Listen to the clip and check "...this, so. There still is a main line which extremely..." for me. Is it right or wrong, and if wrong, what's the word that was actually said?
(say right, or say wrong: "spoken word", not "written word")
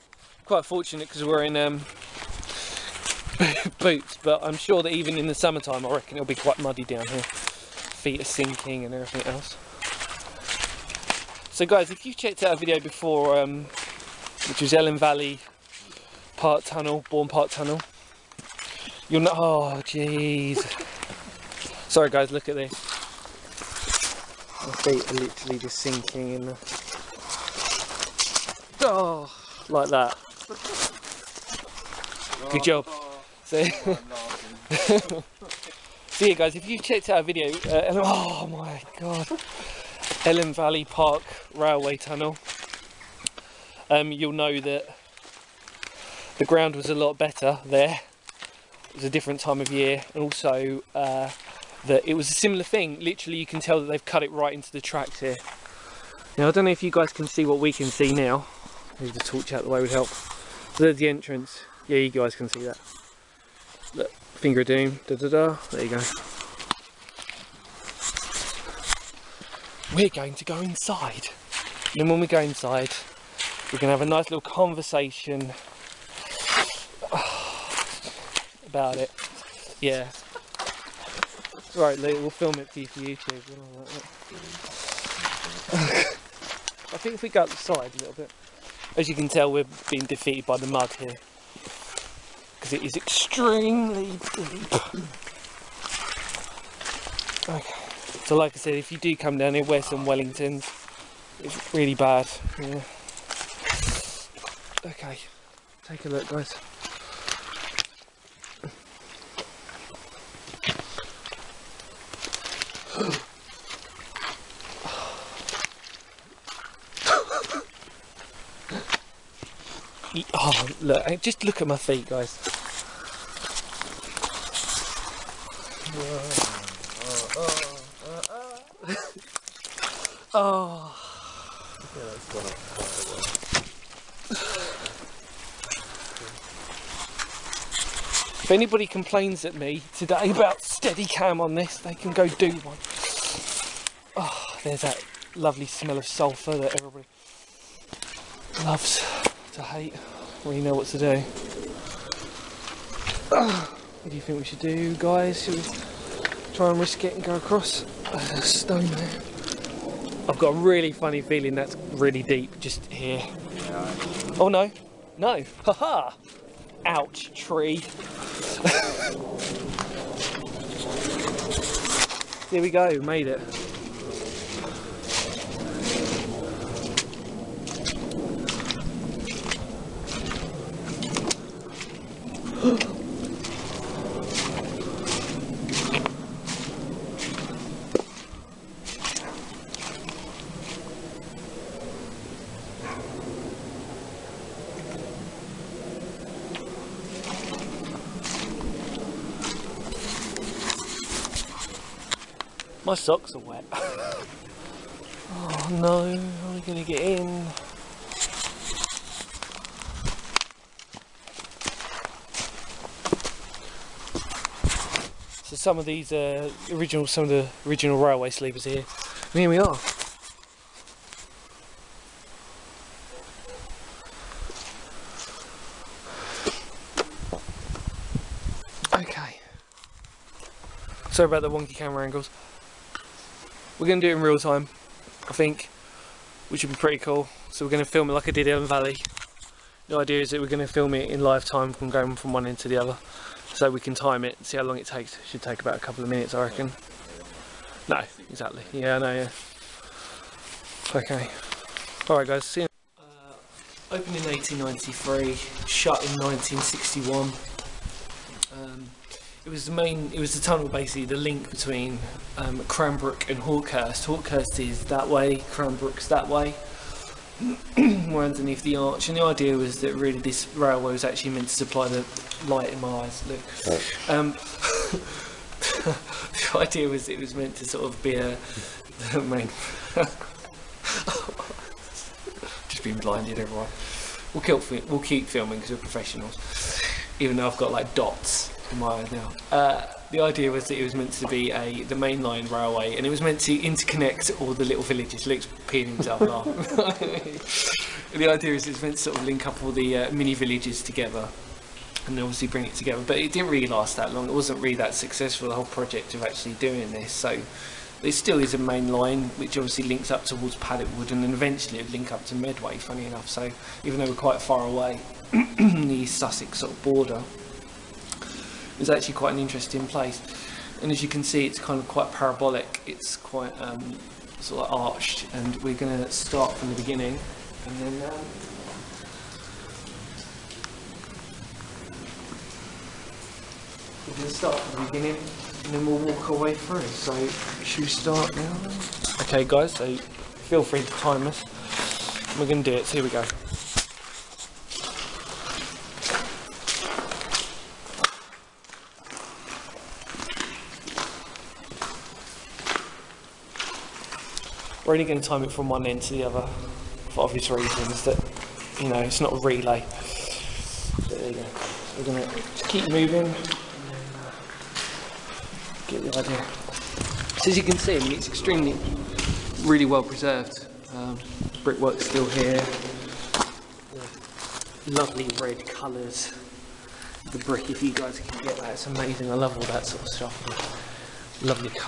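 wrong: "obviously", not "extremely".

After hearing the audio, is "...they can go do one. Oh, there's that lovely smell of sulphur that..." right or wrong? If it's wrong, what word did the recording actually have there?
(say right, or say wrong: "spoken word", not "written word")
right.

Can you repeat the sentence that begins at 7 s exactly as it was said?
Feet are sinking and everything else.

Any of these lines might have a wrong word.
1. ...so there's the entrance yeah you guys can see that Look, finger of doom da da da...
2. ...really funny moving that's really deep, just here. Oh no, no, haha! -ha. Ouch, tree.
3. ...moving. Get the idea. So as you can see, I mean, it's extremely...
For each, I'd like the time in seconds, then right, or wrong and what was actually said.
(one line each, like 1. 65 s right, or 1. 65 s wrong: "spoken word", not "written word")
1. 60 s right
2. 160 s wrong: "feeling", not "moving"
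3. 362 s right.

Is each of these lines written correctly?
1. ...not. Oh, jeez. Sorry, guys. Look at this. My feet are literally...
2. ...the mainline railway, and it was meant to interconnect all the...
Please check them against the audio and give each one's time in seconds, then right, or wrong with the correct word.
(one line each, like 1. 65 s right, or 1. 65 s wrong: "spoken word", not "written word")
1. 19 s right
2. 291 s right.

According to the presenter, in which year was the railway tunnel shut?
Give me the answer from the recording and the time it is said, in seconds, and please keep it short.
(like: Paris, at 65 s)
1961, at 256 s.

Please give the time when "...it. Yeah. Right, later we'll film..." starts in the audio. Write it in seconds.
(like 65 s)
78 s.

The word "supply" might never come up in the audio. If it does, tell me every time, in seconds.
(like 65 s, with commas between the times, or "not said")
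271 s.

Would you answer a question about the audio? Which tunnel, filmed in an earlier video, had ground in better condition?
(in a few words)
Elham Valley Park Tunnel.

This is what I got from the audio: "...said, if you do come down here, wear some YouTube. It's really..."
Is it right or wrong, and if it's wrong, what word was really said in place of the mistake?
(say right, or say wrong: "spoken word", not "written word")
wrong: "Wellingtons", not "YouTube".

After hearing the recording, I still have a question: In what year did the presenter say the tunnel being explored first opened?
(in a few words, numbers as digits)
1893.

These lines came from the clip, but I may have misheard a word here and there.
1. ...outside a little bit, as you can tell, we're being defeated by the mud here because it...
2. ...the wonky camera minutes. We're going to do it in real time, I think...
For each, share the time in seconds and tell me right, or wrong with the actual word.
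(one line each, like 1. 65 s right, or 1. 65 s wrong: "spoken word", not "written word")
1. 87 s right
2. 231 s wrong: "angles", not "minutes".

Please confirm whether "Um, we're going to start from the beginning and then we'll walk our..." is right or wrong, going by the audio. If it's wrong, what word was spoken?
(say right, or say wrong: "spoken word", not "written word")
right.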